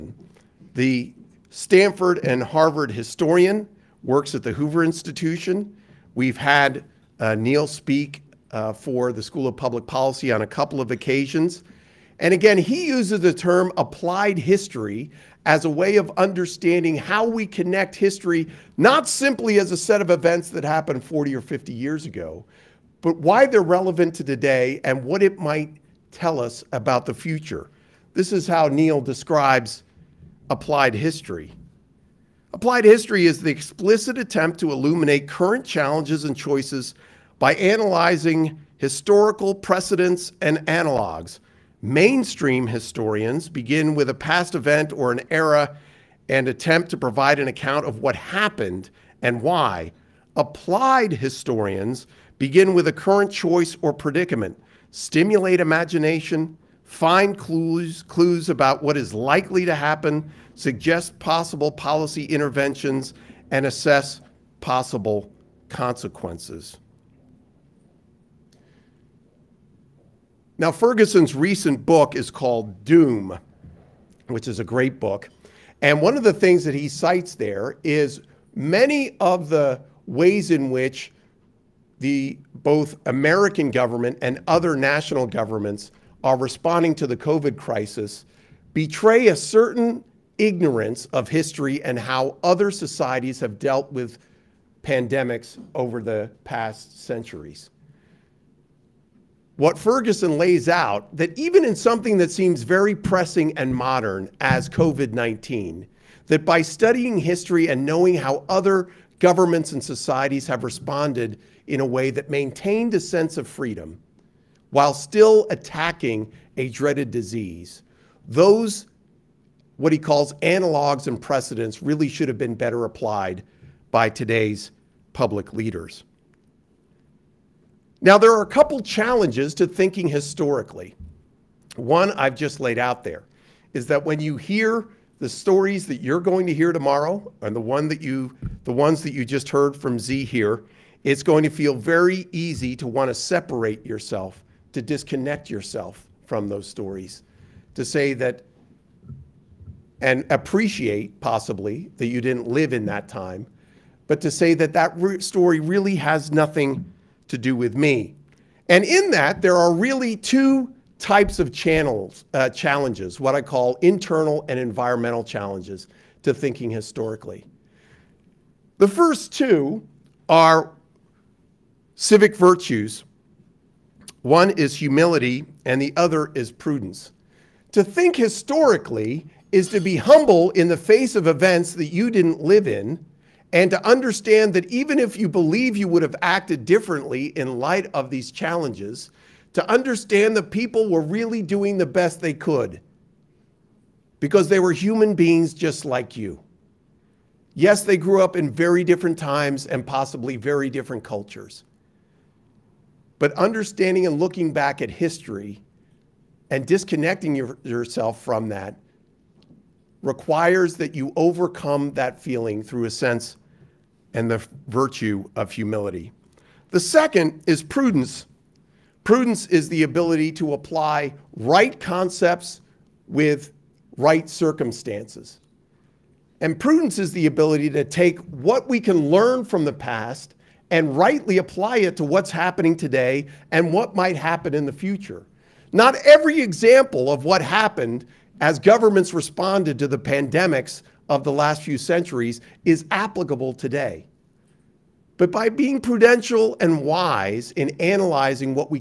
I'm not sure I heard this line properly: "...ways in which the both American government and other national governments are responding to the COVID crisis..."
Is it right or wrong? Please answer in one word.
right.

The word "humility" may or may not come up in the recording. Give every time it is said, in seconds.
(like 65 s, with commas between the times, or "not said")
174 s, 215 s.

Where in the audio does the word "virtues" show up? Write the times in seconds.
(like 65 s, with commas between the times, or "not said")
172 s, 214 s.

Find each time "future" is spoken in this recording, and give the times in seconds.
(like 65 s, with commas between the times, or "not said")
27 s, 234 s.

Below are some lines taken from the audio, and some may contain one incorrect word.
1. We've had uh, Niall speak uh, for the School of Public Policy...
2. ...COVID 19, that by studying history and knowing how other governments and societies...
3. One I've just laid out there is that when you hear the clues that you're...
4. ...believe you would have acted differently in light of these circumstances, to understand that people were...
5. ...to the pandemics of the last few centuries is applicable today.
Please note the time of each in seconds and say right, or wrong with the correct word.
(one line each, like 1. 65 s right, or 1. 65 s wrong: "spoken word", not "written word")
1. 6 s right
2. 104 s right
3. 131 s wrong: "stories", not "clues"
4. 185 s wrong: "challenges", not "circumstances"
5. 239 s right.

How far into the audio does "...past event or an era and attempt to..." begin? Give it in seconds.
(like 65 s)
44 s.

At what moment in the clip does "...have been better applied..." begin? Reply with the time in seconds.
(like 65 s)
122 s.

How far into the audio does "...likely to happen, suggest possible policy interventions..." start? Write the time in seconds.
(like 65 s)
59 s.